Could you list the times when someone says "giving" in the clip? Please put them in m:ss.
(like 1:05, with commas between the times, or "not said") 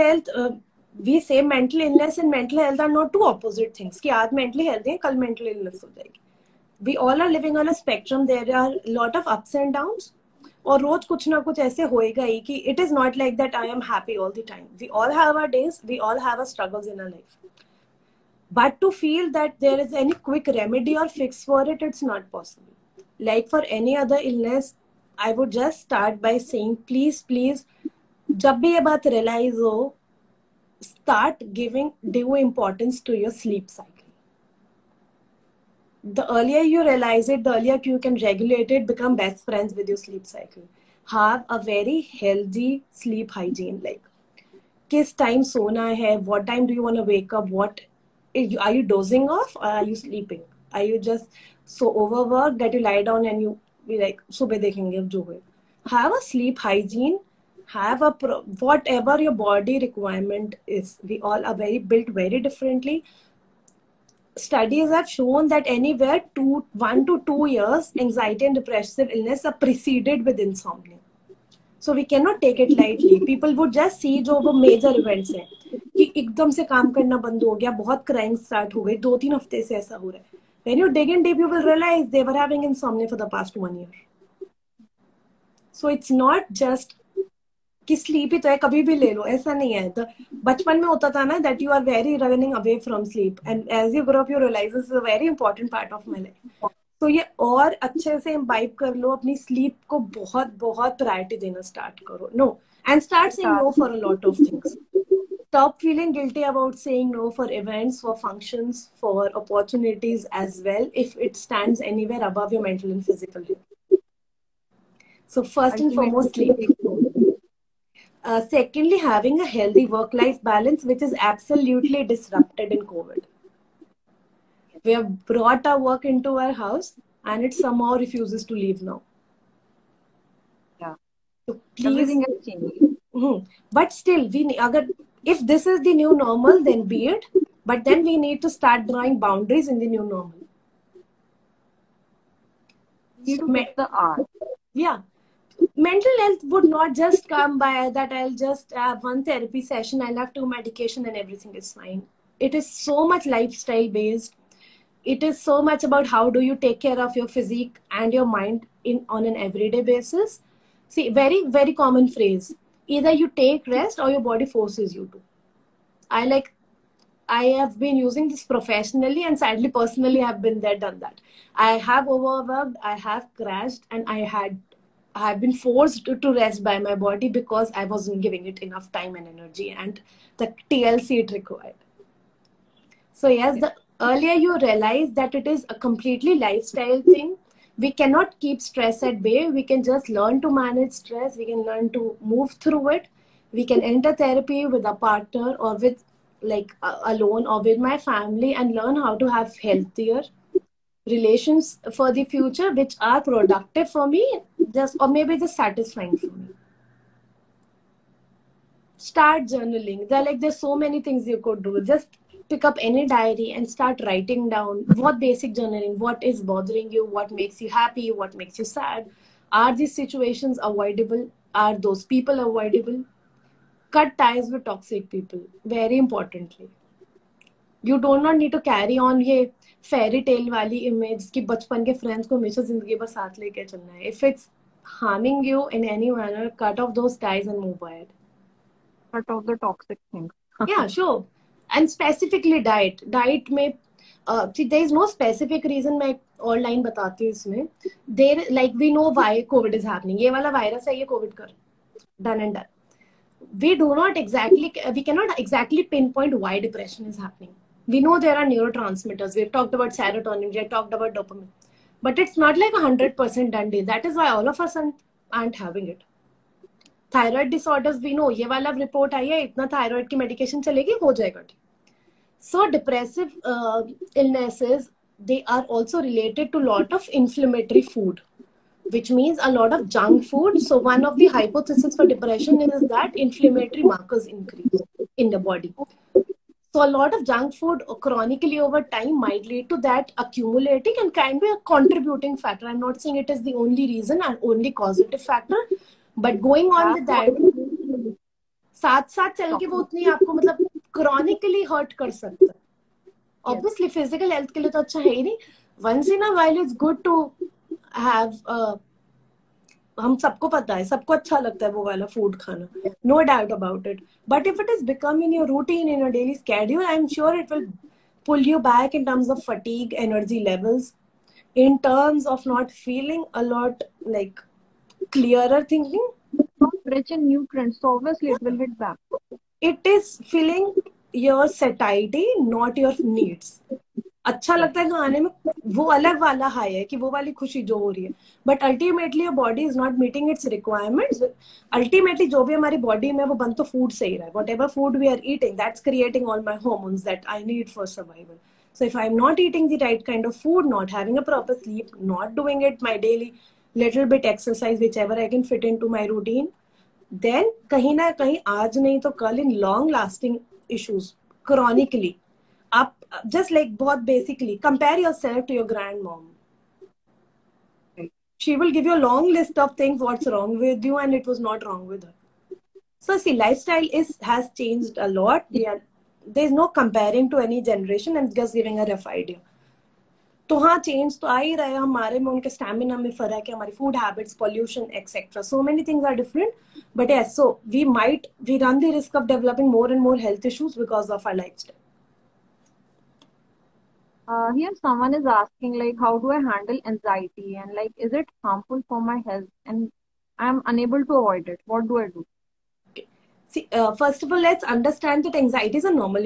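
0:31, 2:58, 6:18.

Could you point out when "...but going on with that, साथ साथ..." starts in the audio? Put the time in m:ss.
4:56.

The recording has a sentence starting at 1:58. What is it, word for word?
Uh, secondly, having a healthy work life balance, which is absolutely disrupted in COVID.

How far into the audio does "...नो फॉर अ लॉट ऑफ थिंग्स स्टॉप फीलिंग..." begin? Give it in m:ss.
1:43.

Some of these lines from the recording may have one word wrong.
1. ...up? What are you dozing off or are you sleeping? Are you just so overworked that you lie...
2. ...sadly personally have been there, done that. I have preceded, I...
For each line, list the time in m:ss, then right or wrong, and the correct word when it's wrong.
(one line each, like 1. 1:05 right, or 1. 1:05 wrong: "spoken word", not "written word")
1. 0:47 right
2. 2:49 wrong: "overworked", not "preceded".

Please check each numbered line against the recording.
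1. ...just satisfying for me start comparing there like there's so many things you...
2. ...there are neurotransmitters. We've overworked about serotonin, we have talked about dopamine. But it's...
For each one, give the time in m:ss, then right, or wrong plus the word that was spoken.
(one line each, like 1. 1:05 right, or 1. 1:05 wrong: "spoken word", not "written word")
1. 3:25 wrong: "journaling", not "comparing"
2. 4:18 wrong: "talked", not "overworked".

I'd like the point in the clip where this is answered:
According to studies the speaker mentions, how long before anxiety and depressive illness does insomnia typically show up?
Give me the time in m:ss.
1:06.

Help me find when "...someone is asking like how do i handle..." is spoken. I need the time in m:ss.
6:34.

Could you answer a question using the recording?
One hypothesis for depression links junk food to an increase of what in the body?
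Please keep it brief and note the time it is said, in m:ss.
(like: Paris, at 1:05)
Inflammatory markers, at 4:43.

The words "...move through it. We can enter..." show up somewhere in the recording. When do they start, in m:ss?
3:12.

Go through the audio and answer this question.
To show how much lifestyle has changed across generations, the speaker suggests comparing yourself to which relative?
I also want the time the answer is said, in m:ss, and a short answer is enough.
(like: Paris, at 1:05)
Grandmom, at 6:05.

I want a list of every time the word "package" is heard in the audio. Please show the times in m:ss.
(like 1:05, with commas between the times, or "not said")
not said.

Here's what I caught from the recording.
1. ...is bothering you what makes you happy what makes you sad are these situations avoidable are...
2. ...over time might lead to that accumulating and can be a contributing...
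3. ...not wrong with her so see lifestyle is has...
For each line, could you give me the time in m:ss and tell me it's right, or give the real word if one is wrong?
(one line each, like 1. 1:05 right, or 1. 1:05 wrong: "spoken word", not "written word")
1. 3:36 right
2. 4:48 right
3. 6:11 right.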